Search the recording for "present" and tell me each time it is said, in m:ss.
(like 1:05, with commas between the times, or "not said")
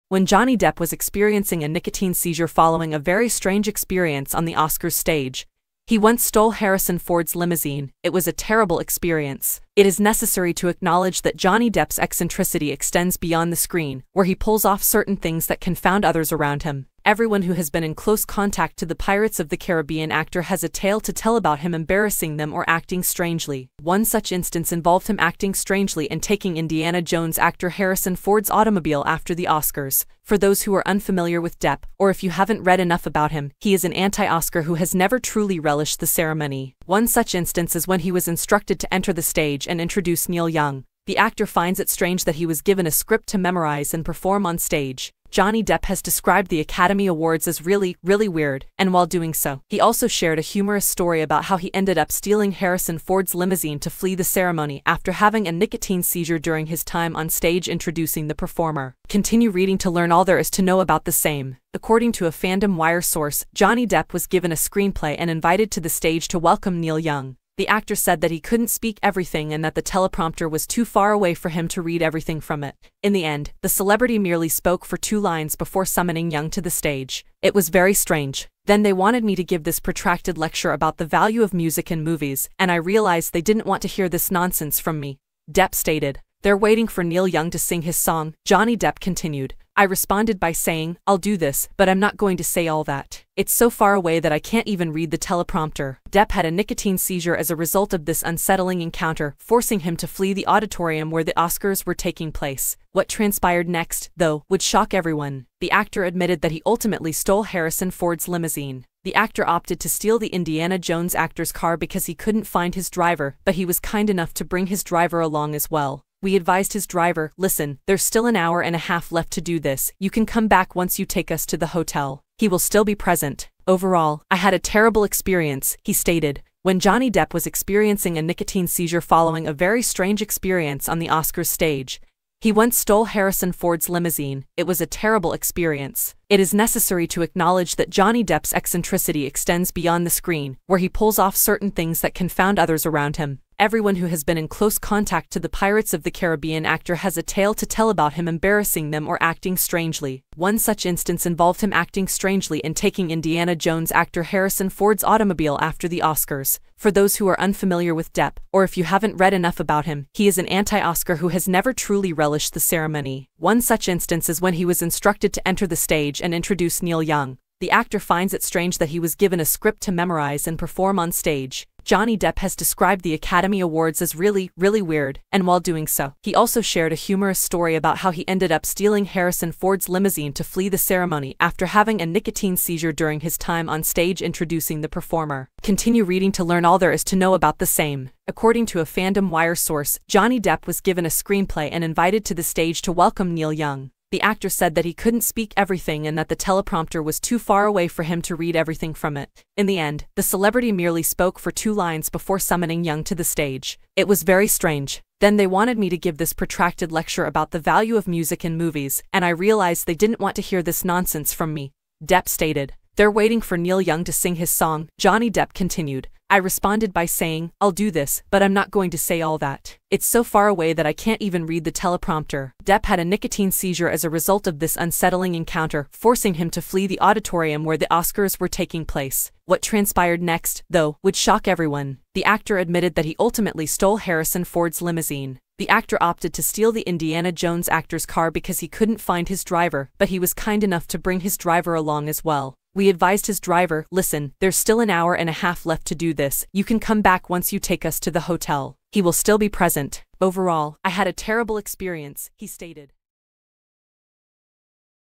2:02, 4:09.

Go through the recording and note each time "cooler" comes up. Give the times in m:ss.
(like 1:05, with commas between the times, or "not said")
not said.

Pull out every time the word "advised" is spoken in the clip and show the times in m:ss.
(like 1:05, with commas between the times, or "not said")
1:56, 4:02.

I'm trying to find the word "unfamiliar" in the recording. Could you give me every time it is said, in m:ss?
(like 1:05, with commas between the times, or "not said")
0:30, 2:37.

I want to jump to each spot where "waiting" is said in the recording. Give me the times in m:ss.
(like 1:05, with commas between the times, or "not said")
1:26, 3:33.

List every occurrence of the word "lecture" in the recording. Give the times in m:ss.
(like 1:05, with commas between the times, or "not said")
1:20, 3:26.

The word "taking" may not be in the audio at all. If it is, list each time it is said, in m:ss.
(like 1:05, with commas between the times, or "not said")
0:26, 1:41, 2:32, 3:48.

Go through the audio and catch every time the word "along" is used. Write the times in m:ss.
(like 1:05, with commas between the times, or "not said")
1:55, 4:01.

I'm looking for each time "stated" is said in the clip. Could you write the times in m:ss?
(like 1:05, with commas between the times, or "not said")
1:25, 2:05, 3:32, 4:12.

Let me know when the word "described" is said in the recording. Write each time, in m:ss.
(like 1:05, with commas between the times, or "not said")
0:46, 2:52.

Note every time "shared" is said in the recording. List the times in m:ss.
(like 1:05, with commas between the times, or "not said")
0:50, 2:56.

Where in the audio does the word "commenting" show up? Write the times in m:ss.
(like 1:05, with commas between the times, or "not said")
not said.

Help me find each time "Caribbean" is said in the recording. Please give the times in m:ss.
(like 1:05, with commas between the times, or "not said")
0:19, 2:26.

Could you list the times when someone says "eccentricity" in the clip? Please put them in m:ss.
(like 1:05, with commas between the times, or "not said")
0:11, 2:18.